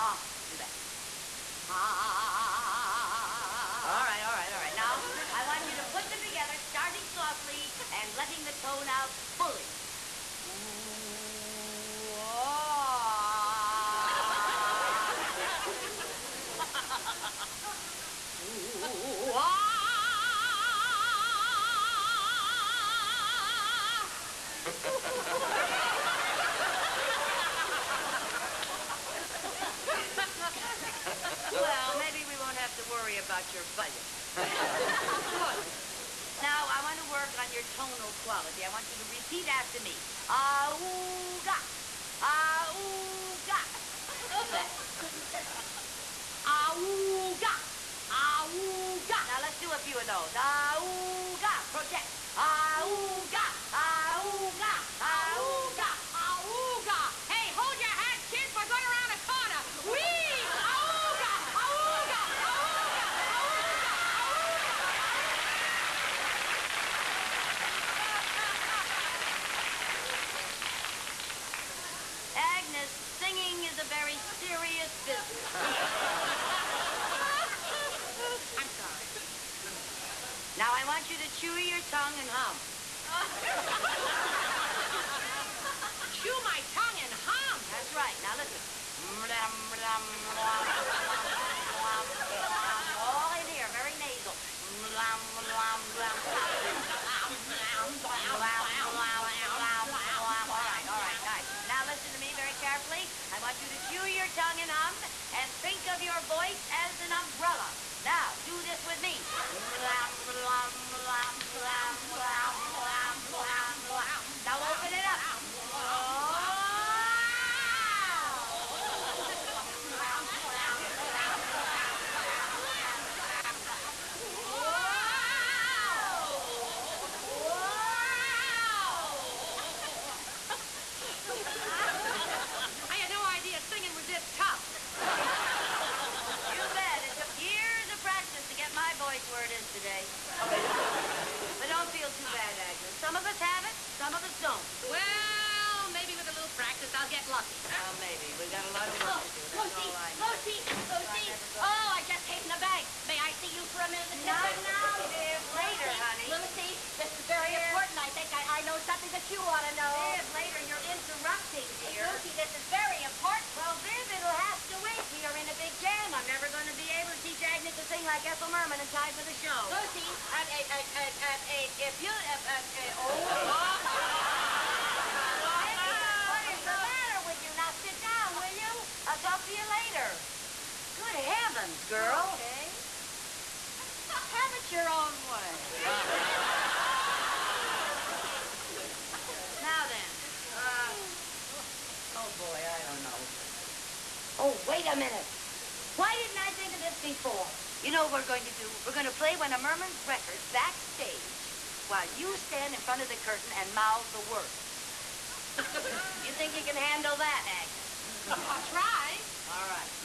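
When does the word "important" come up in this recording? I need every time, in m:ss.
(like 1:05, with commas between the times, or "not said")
2:37, 2:43.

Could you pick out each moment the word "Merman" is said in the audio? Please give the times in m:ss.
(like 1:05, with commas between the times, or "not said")
2:48, 3:19.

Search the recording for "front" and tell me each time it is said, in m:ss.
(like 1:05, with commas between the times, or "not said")
3:22.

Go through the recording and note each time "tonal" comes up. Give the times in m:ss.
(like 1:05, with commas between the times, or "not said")
0:37.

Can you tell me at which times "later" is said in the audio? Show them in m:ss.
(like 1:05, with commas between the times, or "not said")
2:35, 2:40, 2:59.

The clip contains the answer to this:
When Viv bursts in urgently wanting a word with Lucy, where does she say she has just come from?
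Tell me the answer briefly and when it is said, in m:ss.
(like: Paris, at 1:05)
the bank, at 2:32.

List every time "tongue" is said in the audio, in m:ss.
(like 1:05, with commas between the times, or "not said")
1:21, 1:26, 1:44.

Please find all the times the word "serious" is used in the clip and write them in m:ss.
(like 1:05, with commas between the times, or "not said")
1:14.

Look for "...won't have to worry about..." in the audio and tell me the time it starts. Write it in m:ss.
0:32.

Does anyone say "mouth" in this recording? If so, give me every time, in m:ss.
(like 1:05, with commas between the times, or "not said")
3:23.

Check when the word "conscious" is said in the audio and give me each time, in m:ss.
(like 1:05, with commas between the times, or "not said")
not said.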